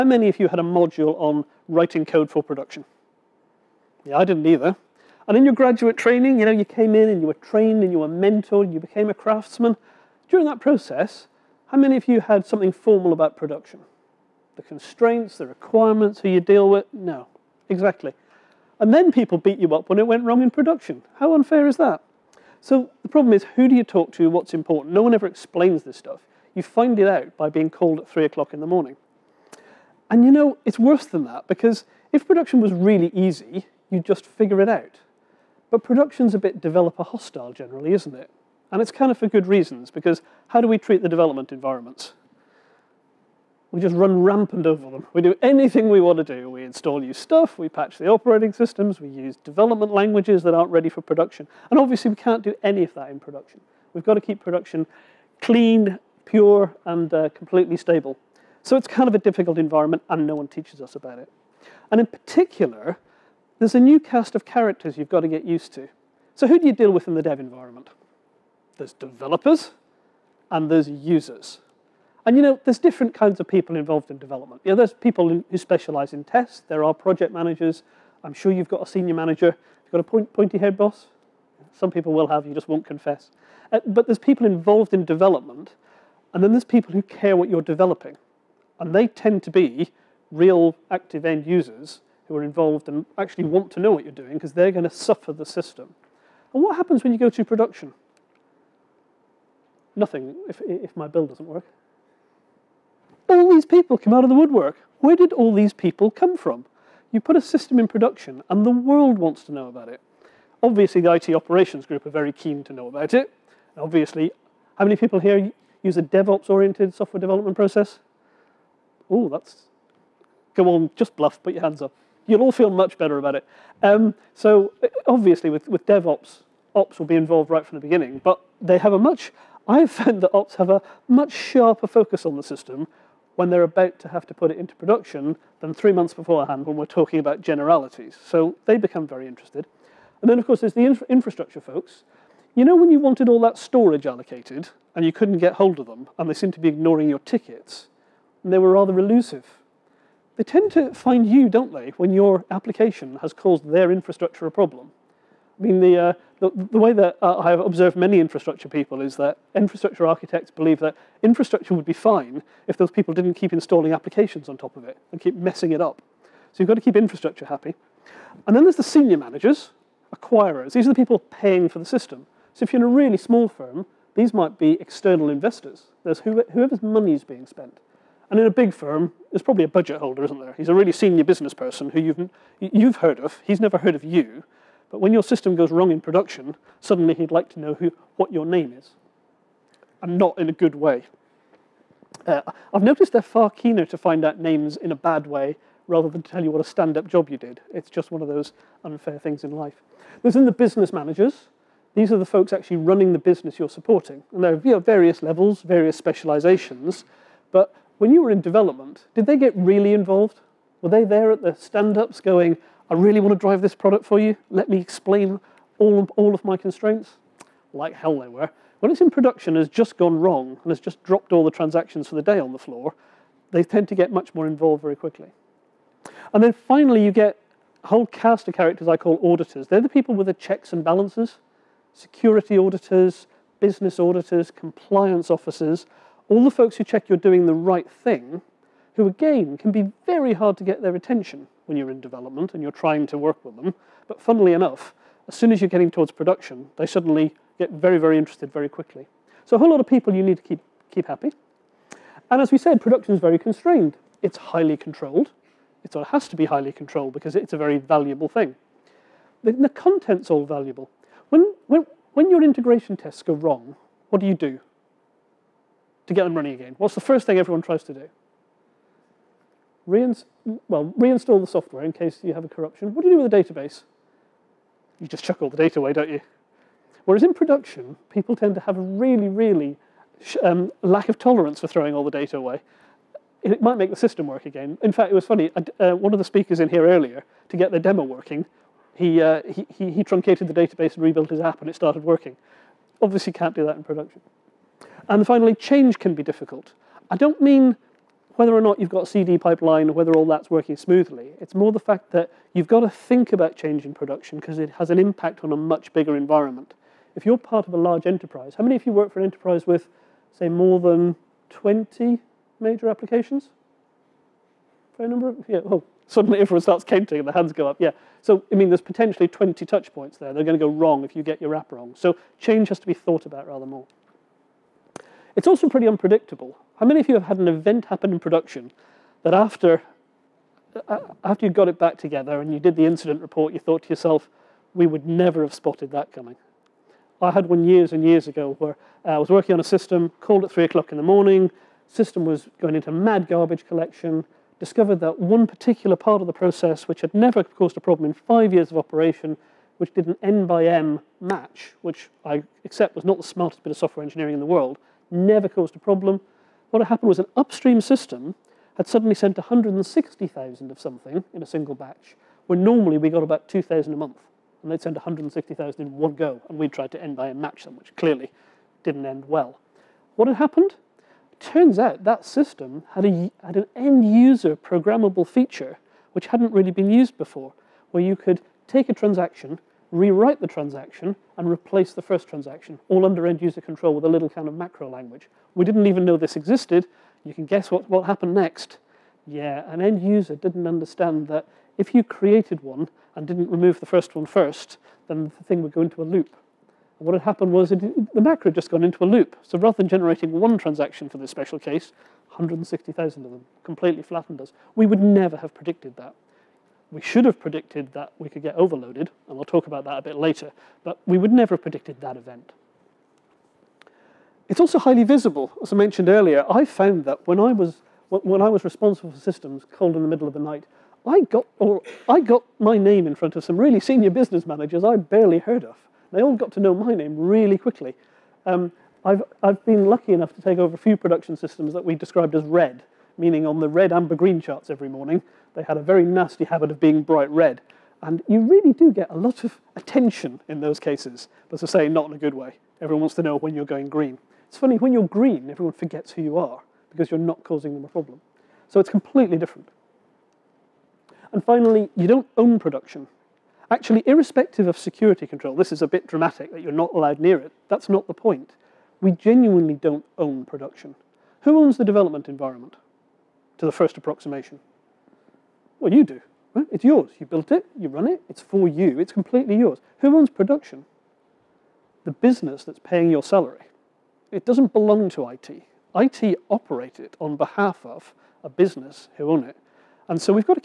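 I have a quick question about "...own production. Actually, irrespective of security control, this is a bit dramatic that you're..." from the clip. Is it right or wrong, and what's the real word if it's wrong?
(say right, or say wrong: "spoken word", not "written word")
right.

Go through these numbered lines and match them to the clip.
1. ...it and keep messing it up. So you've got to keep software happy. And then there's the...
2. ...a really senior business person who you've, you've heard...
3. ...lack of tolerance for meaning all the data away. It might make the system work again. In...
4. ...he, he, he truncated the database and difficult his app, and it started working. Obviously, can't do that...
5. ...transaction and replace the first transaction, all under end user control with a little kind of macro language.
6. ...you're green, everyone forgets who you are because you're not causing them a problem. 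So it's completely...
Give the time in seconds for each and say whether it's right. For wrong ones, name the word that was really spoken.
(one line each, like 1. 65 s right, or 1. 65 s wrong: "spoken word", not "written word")
1. 164 s wrong: "infrastructure", not "software"
2. 180 s right
3. 280 s wrong: "throwing", not "meaning"
4. 289 s wrong: "rebuilt", not "difficult"
5. 380 s right
6. 444 s right.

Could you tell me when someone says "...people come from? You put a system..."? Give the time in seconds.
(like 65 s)
105 s.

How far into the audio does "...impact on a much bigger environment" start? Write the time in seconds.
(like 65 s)
304 s.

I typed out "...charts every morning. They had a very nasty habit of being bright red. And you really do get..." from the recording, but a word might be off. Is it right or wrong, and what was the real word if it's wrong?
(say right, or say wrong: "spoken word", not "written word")
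right.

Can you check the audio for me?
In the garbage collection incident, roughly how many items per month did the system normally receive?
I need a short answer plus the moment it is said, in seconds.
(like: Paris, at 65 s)
about 2,000, at 363 s.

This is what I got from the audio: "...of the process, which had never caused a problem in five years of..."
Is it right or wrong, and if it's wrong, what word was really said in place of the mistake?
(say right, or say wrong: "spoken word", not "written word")
right.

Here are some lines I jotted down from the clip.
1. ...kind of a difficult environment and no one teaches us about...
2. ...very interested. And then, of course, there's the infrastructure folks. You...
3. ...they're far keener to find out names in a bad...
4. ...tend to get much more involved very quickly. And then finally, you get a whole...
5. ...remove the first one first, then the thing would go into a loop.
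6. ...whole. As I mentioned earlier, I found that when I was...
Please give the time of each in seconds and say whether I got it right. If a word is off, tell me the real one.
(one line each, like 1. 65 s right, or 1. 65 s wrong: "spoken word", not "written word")
1. 58 s right
2. 139 s right
3. 193 s right
4. 223 s right
5. 393 s right
6. 415 s wrong: "visible", not "whole".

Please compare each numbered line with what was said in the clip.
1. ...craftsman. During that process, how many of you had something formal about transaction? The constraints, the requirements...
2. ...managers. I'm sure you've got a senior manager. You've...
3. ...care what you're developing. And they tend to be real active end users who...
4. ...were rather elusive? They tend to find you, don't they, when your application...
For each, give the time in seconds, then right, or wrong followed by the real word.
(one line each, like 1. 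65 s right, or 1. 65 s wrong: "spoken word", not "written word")
1. 9 s wrong: "production", not "transaction"
2. 77 s right
3. 87 s right
4. 148 s right.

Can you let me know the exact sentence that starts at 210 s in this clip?
Were they there at the stand-ups going, I really want to drive this product for you.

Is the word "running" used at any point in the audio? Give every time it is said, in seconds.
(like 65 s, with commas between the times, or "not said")
202 s, 266 s.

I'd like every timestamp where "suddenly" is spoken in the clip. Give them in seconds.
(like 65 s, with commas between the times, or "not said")
186 s, 246 s, 316 s, 358 s.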